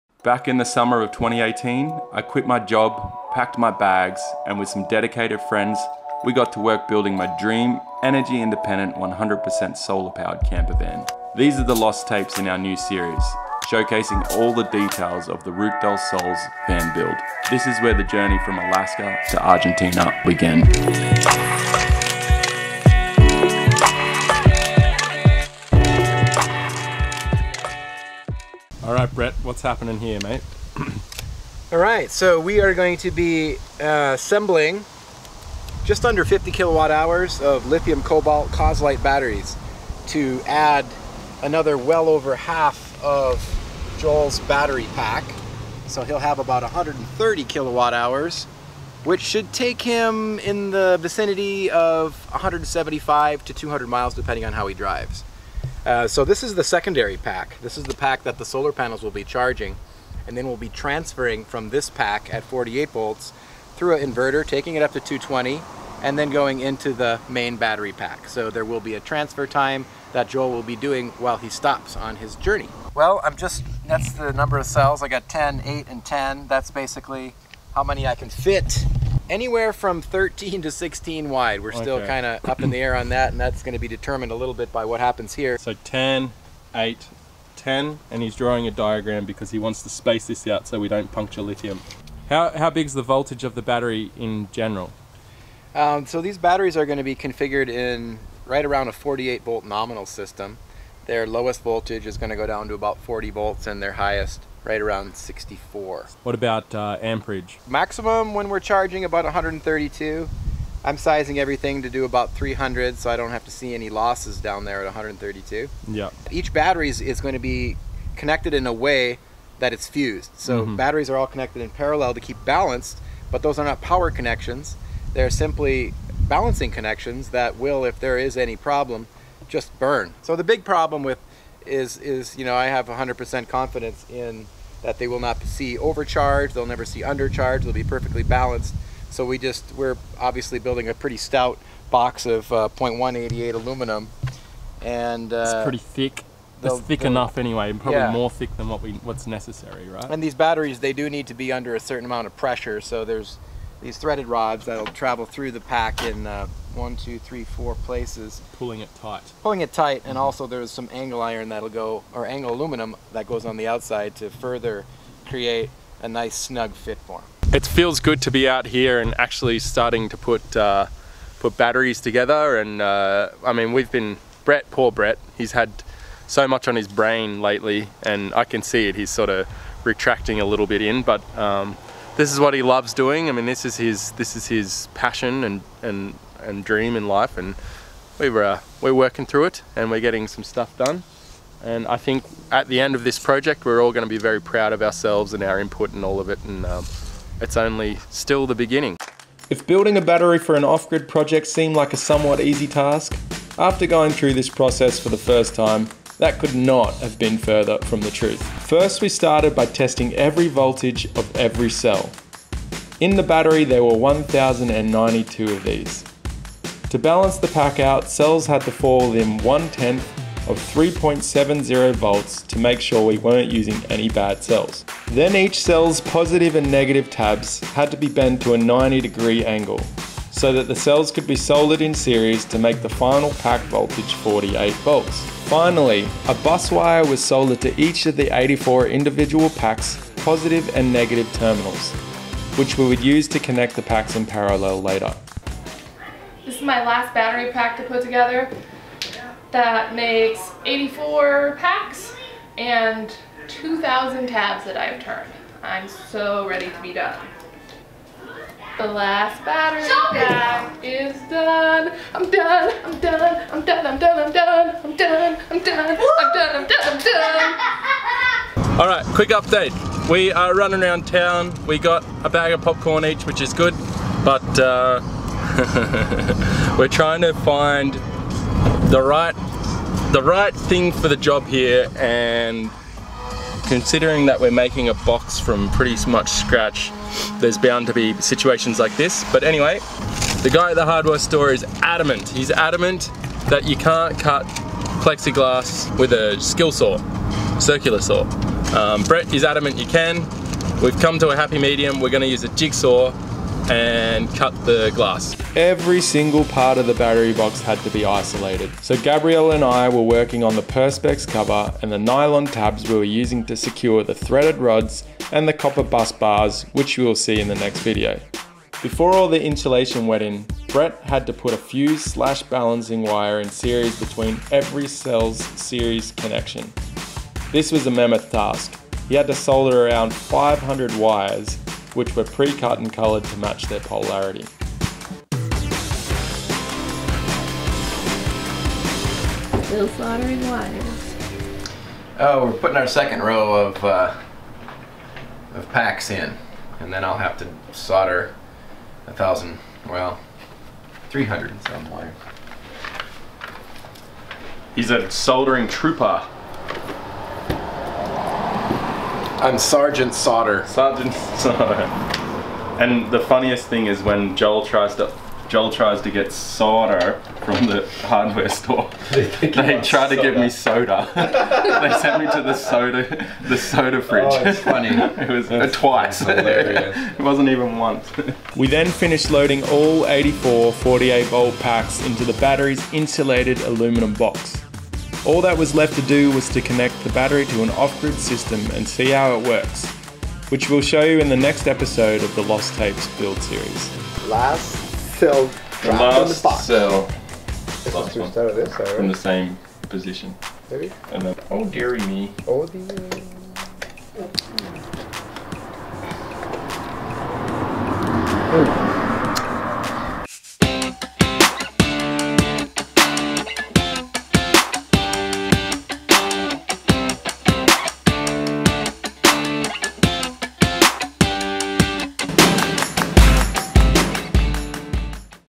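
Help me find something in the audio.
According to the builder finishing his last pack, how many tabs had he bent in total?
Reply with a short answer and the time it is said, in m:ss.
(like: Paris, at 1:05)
2,000, at 4:13.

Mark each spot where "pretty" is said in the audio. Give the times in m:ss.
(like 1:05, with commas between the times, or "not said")
2:20, 2:25, 4:45.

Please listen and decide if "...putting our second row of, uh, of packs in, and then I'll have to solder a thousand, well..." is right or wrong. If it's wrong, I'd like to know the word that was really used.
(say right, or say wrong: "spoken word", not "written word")
right.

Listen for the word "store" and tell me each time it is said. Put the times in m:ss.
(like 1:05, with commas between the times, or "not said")
4:51, 6:08.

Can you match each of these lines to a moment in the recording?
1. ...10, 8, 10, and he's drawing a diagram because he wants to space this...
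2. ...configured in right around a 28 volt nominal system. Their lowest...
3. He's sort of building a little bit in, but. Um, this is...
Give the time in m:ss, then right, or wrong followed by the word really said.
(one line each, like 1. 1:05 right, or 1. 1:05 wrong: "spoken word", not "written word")
1. 1:25 right
2. 1:37 wrong: "48", not "28"
3. 2:58 wrong: "retracting", not "building".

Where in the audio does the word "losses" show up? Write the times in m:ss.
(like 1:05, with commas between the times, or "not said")
1:53.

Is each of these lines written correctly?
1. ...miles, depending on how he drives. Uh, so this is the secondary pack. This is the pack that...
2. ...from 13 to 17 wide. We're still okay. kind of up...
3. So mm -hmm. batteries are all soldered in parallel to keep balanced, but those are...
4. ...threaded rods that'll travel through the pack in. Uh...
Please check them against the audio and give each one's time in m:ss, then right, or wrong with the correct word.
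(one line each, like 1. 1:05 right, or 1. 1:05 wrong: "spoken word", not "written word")
1. 0:53 right
2. 1:19 wrong: "16", not "17"
3. 2:00 wrong: "connected", not "soldered"
4. 2:33 right.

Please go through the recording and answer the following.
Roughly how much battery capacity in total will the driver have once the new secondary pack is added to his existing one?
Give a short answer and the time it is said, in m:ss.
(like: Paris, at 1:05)
130 kilowatt hours, at 0:46.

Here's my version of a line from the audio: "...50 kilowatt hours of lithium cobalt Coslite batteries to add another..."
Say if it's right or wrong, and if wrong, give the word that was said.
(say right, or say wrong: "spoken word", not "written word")
right.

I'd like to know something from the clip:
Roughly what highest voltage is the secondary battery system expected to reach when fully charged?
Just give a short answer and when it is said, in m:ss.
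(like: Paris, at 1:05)
64, at 1:45.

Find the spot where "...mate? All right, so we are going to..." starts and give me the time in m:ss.
0:30.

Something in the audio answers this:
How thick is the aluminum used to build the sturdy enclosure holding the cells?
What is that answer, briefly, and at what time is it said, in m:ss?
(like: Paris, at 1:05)
0.188, at 2:22.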